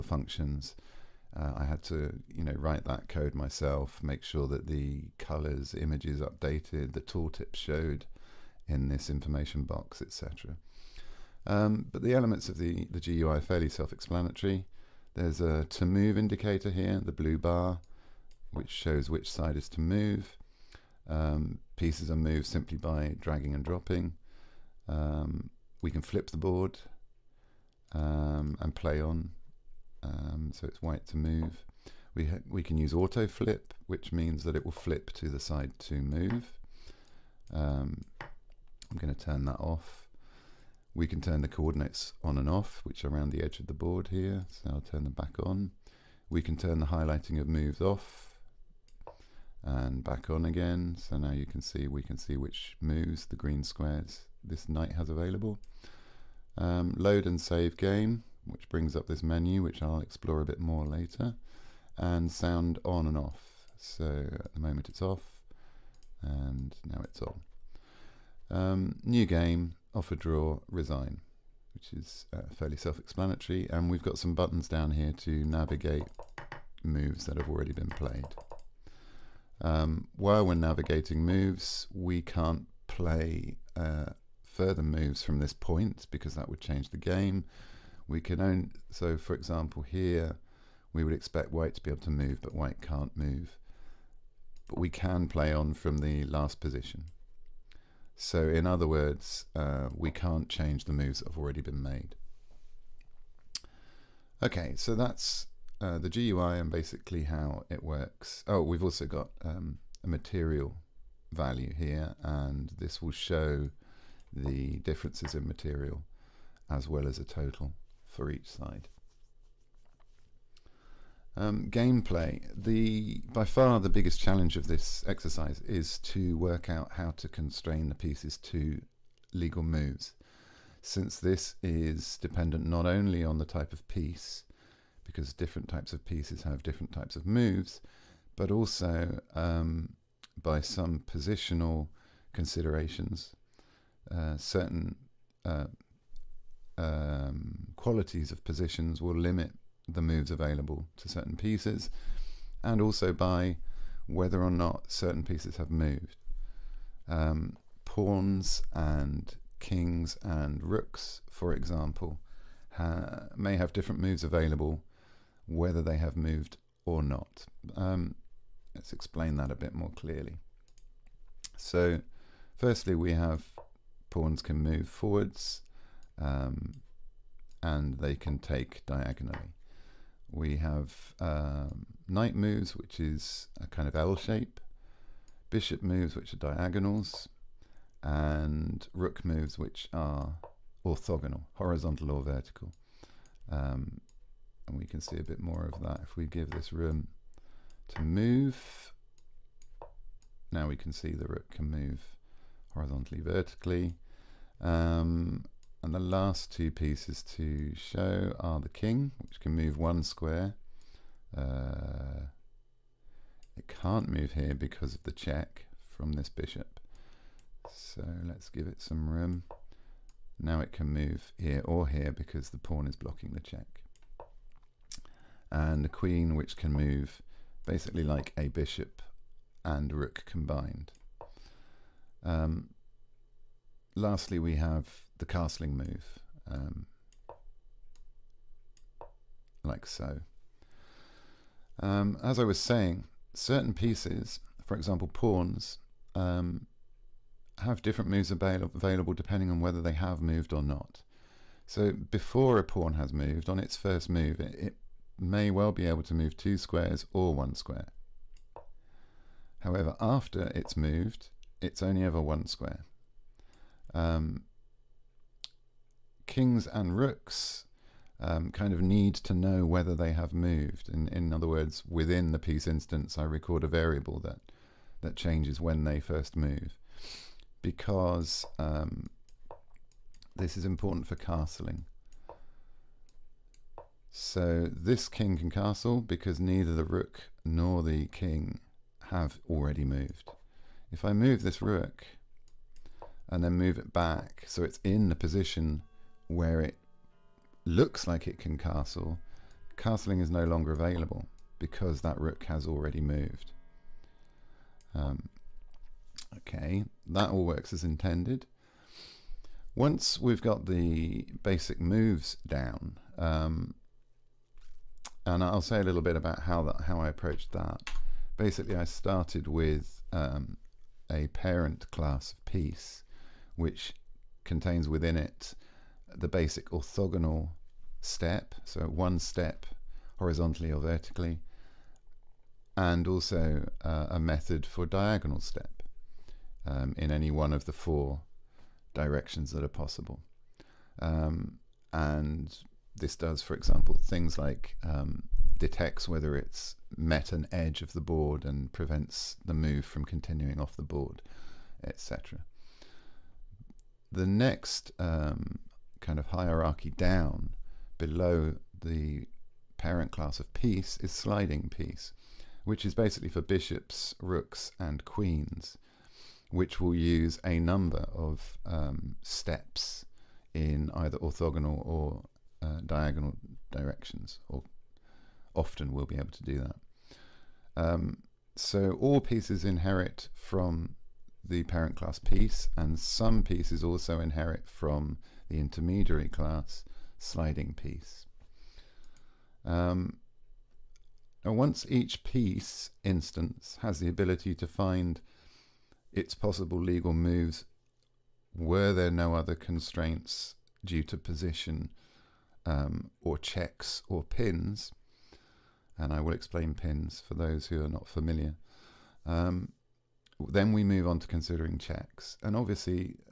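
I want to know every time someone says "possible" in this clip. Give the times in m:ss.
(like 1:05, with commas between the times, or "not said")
5:39, 6:36.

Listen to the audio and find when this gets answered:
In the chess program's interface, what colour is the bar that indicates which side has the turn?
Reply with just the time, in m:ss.
0:17.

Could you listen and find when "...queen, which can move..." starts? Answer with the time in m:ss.
3:45.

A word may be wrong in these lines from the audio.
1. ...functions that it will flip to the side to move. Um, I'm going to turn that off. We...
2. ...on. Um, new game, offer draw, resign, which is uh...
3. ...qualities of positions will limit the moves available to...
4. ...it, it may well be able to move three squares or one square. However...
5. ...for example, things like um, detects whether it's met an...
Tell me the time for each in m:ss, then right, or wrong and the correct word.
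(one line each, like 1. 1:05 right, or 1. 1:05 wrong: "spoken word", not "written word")
1. 0:34 wrong: "means", not "functions"
2. 1:07 right
3. 2:27 right
4. 4:14 wrong: "two", not "three"
5. 5:43 right.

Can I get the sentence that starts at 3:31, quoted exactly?
Uh, it can't move here because of the check from this bishop.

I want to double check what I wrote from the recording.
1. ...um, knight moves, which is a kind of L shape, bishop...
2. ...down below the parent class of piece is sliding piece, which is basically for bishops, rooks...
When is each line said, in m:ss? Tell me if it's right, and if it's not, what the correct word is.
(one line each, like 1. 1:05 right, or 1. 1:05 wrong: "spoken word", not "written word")
1. 3:01 right
2. 5:56 right.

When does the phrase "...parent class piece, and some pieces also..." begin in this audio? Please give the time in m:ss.
6:21.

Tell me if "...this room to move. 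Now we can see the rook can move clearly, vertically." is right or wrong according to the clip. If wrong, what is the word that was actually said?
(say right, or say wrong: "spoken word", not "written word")
wrong: "horizontally", not "clearly".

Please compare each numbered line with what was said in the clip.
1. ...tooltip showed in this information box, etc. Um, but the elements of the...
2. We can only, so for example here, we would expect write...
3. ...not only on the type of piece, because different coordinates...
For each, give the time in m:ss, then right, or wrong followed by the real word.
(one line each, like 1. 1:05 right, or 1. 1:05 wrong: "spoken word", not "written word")
1. 0:06 right
2. 1:28 wrong: "white", not "write"
3. 2:12 wrong: "types", not "coordinates".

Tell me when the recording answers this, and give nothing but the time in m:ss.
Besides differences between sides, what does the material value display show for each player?
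1:57.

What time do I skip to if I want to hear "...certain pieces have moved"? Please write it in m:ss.
2:34.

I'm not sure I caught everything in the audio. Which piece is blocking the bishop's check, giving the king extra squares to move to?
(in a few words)
The pawn.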